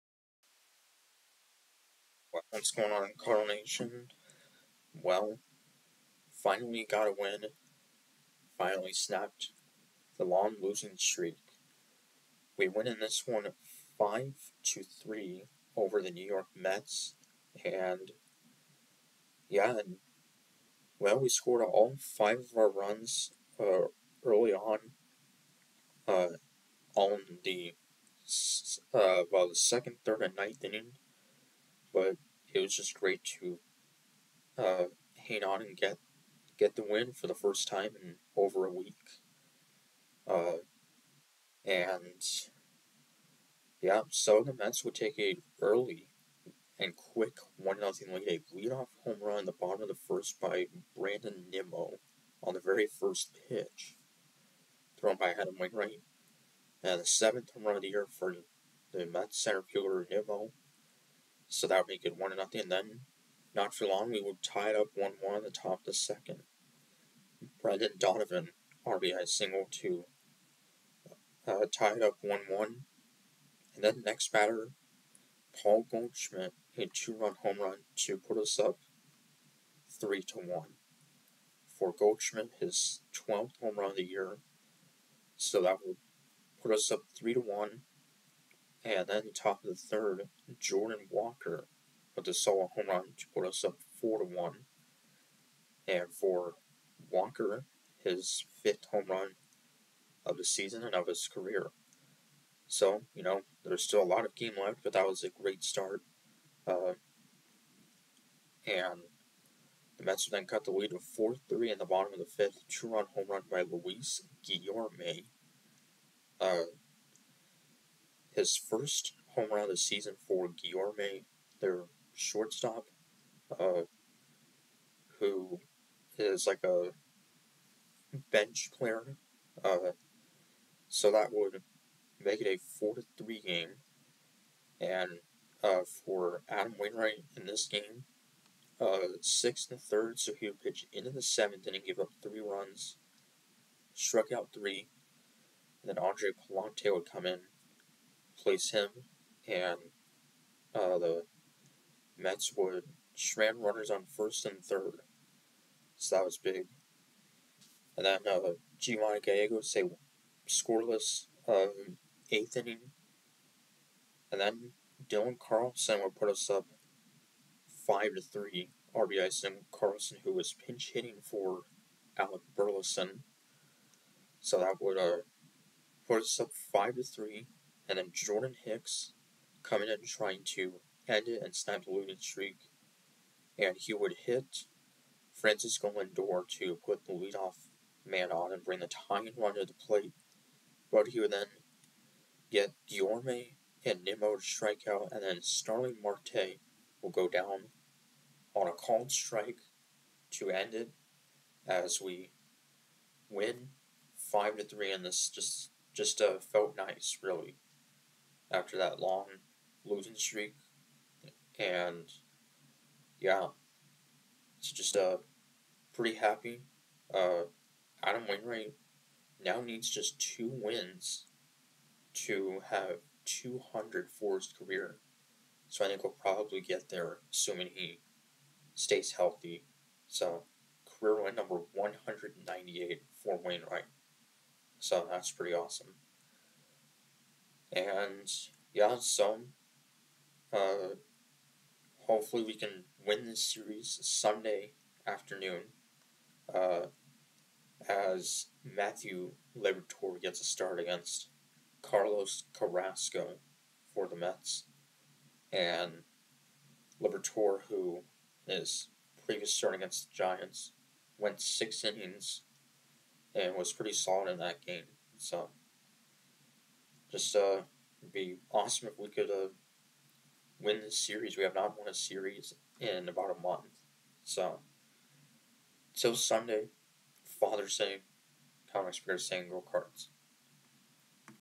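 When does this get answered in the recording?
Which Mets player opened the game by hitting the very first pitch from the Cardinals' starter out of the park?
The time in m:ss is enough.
0:50.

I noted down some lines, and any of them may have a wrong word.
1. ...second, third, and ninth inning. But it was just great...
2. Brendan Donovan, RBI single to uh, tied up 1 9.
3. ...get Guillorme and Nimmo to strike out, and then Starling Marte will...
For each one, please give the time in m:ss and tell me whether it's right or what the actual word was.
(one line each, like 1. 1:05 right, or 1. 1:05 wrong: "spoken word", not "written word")
1. 0:29 right
2. 1:07 wrong: "1", not "9"
3. 3:12 right.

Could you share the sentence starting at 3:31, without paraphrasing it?
And yeah, it's just uh, pretty happy.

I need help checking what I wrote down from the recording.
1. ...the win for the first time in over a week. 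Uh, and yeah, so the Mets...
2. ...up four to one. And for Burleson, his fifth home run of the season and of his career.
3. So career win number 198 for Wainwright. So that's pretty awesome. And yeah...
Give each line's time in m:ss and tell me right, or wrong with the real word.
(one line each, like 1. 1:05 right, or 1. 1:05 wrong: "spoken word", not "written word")
1. 0:36 right
2. 1:33 wrong: "Walker", not "Burleson"
3. 3:50 right.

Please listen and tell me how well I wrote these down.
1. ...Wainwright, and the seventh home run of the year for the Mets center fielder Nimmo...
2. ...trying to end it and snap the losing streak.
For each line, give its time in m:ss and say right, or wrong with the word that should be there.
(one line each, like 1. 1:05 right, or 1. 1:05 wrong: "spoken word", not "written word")
1. 0:55 right
2. 3:00 right.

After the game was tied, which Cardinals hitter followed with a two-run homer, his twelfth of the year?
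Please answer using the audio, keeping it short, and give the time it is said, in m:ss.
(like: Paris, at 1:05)
Paul Goldschmidt, at 1:15.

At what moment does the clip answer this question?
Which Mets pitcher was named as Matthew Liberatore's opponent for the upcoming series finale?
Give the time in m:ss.
4:11.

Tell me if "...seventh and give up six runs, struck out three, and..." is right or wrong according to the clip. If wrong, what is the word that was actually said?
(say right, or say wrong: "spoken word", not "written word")
wrong: "three", not "six".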